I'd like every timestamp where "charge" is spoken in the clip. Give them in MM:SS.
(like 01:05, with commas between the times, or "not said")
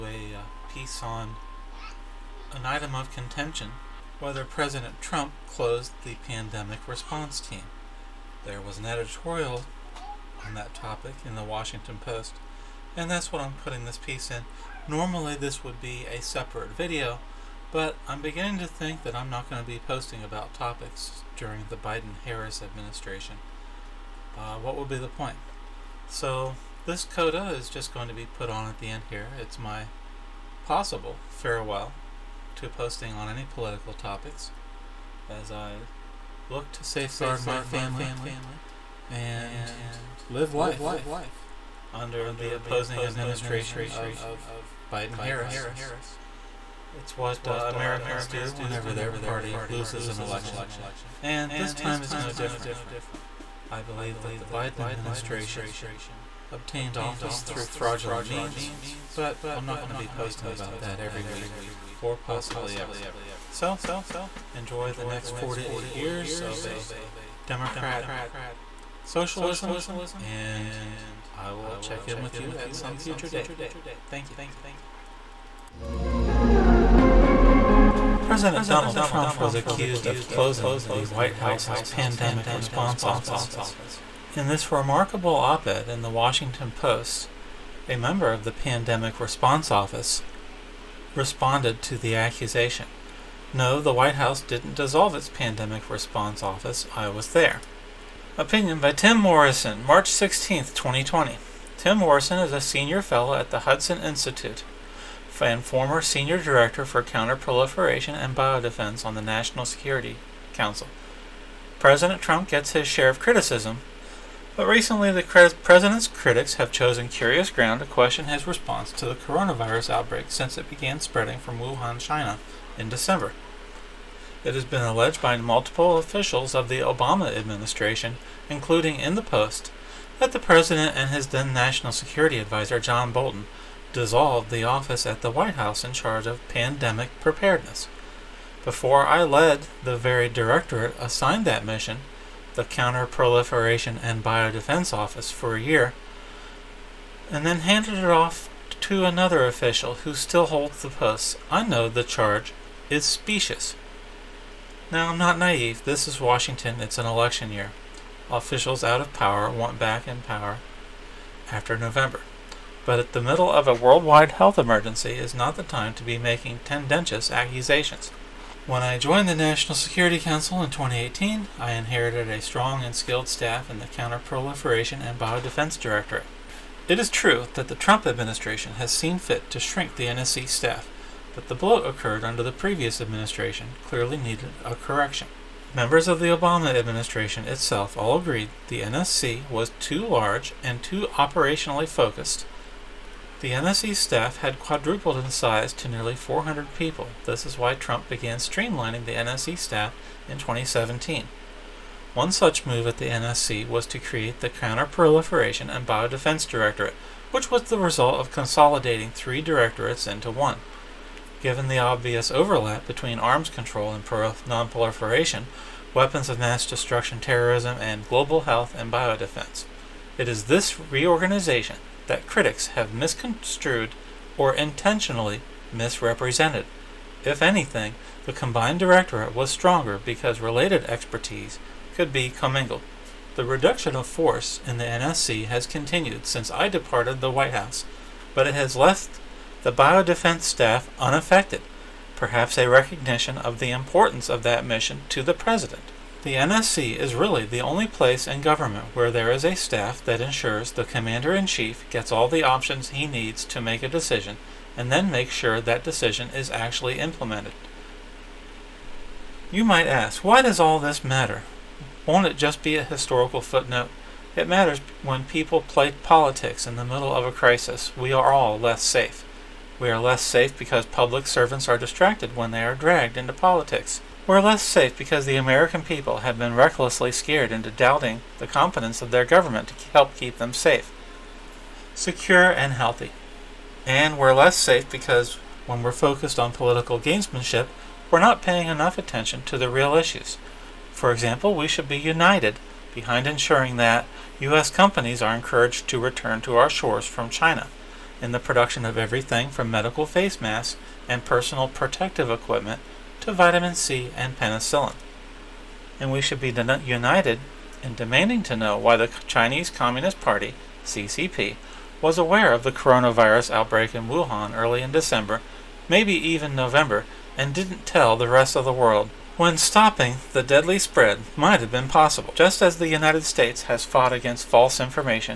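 02:15, 02:32.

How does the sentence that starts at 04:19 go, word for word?
You might ask, why does all this matter?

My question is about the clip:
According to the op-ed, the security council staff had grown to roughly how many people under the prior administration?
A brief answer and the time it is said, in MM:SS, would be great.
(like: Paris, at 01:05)
400, at 03:16.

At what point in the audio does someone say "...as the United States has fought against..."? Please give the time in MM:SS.
05:22.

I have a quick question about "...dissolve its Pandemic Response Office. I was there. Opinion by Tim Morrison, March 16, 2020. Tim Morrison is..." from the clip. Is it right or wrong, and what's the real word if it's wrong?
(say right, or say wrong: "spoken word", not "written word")
right.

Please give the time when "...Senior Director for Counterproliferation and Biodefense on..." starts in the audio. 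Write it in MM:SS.
01:46.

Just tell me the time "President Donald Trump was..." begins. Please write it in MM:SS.
01:18.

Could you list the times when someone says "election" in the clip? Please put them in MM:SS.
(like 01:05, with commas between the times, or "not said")
00:50, 02:37.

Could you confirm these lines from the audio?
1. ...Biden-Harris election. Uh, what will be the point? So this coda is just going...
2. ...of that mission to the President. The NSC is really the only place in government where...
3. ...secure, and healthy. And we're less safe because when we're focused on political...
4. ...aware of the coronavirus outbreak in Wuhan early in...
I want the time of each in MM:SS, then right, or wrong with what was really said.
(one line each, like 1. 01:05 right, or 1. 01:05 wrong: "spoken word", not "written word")
1. 00:21 wrong: "administration", not "election"
2. 04:04 right
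3. 04:41 right
4. 05:12 right.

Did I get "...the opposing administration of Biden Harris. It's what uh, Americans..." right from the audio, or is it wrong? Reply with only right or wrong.
right.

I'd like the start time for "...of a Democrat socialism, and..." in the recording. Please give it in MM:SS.
01:06.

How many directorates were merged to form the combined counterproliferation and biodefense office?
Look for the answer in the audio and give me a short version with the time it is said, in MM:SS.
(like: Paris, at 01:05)
3, at 03:29.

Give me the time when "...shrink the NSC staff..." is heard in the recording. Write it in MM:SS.
02:59.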